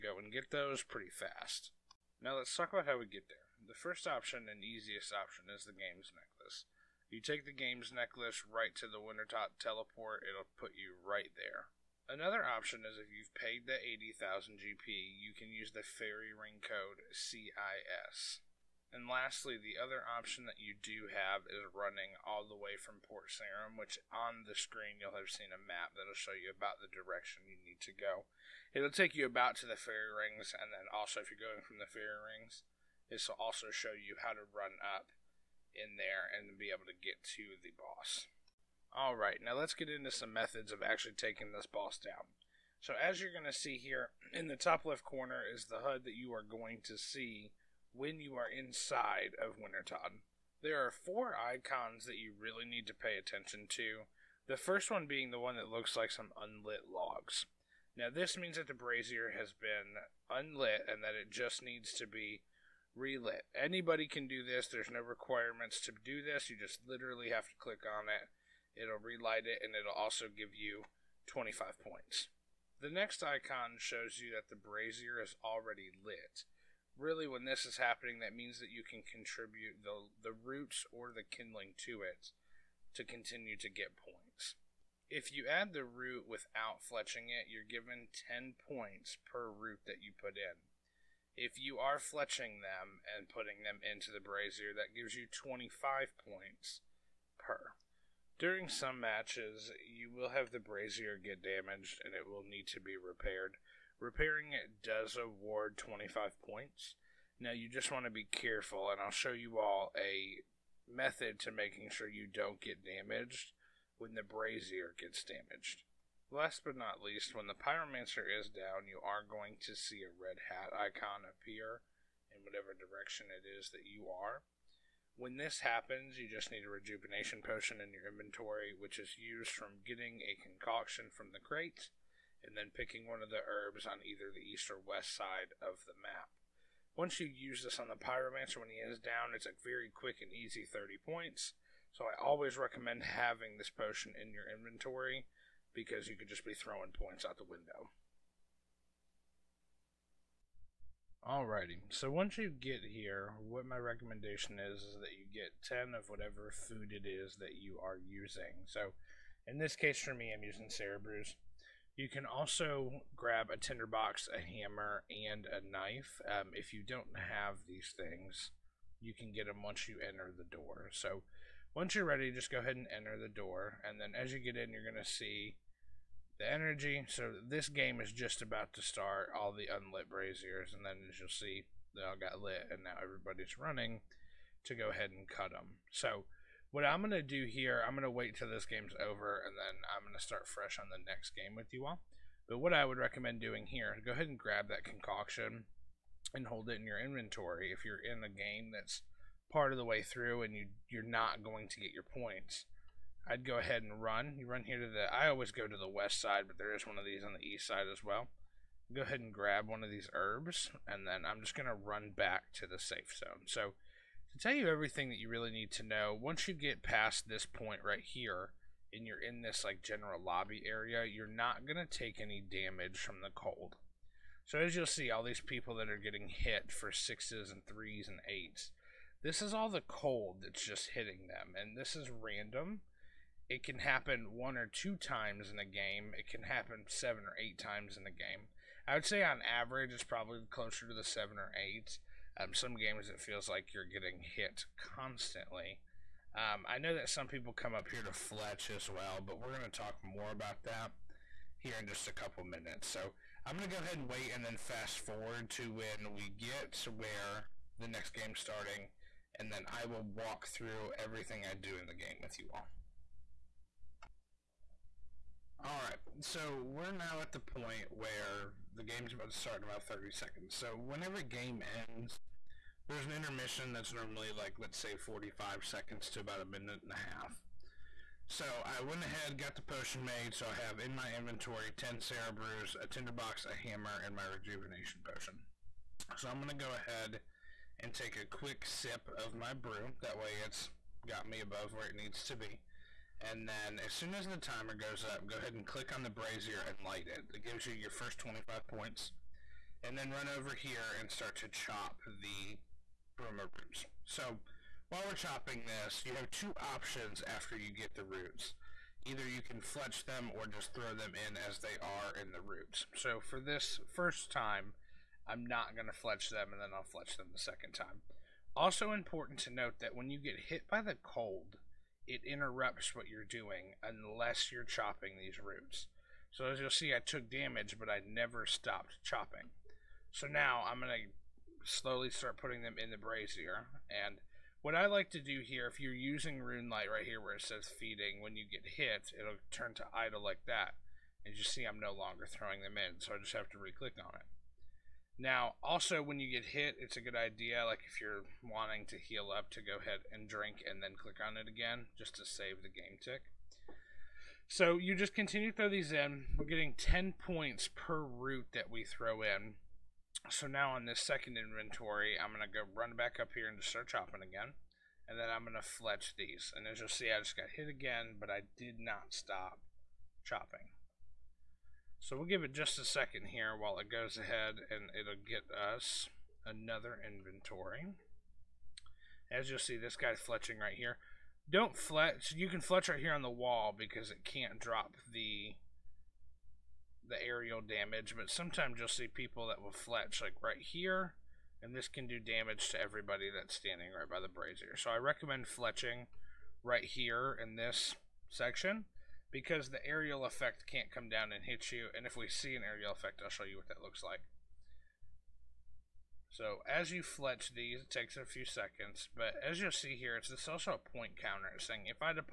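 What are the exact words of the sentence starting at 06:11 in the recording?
So we'll give it just a second here while it goes ahead and it'll get us another inventory.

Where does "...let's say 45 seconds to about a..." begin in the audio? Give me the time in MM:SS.
04:34.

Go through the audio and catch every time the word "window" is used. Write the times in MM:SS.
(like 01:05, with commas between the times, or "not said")
02:27.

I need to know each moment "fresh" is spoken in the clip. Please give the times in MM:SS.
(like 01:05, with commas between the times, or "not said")
03:10.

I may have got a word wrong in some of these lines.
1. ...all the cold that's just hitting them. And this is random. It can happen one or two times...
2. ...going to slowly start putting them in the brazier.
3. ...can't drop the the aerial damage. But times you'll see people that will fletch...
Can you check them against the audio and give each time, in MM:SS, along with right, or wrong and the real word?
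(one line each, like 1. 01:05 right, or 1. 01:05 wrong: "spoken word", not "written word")
1. 03:49 right
2. 05:30 right
3. 06:24 wrong: "sometimes", not "times".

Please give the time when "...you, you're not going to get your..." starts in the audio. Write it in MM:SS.
03:20.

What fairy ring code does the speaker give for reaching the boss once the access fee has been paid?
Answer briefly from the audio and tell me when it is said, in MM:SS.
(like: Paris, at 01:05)
CIS, at 00:17.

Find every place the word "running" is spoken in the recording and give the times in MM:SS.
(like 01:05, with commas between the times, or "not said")
00:21, 03:03.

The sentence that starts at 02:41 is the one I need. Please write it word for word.
You can also grab a tinderbox, a hammer, and a knife.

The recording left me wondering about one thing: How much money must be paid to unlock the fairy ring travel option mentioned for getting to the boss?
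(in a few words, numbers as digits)
80,000 GP.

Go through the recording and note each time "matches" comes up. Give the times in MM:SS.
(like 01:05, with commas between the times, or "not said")
01:38.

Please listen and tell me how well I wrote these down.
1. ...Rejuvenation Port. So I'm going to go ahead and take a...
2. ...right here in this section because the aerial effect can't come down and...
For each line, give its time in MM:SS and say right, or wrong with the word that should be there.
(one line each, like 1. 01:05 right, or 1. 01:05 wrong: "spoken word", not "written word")
1. 04:44 wrong: "Potion", not "Port"
2. 06:36 right.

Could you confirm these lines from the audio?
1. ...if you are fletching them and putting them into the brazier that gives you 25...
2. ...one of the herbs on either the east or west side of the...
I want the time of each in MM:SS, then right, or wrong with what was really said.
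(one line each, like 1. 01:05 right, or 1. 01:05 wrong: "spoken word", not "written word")
1. 01:31 right
2. 02:13 right.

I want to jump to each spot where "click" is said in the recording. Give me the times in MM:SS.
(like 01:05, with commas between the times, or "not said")
01:07, 04:55, 05:43, 05:50.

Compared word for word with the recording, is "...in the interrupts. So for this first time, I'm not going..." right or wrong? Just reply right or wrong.
wrong.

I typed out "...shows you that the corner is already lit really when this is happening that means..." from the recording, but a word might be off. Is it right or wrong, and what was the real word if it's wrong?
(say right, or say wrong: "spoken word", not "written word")
wrong: "brazier", not "corner".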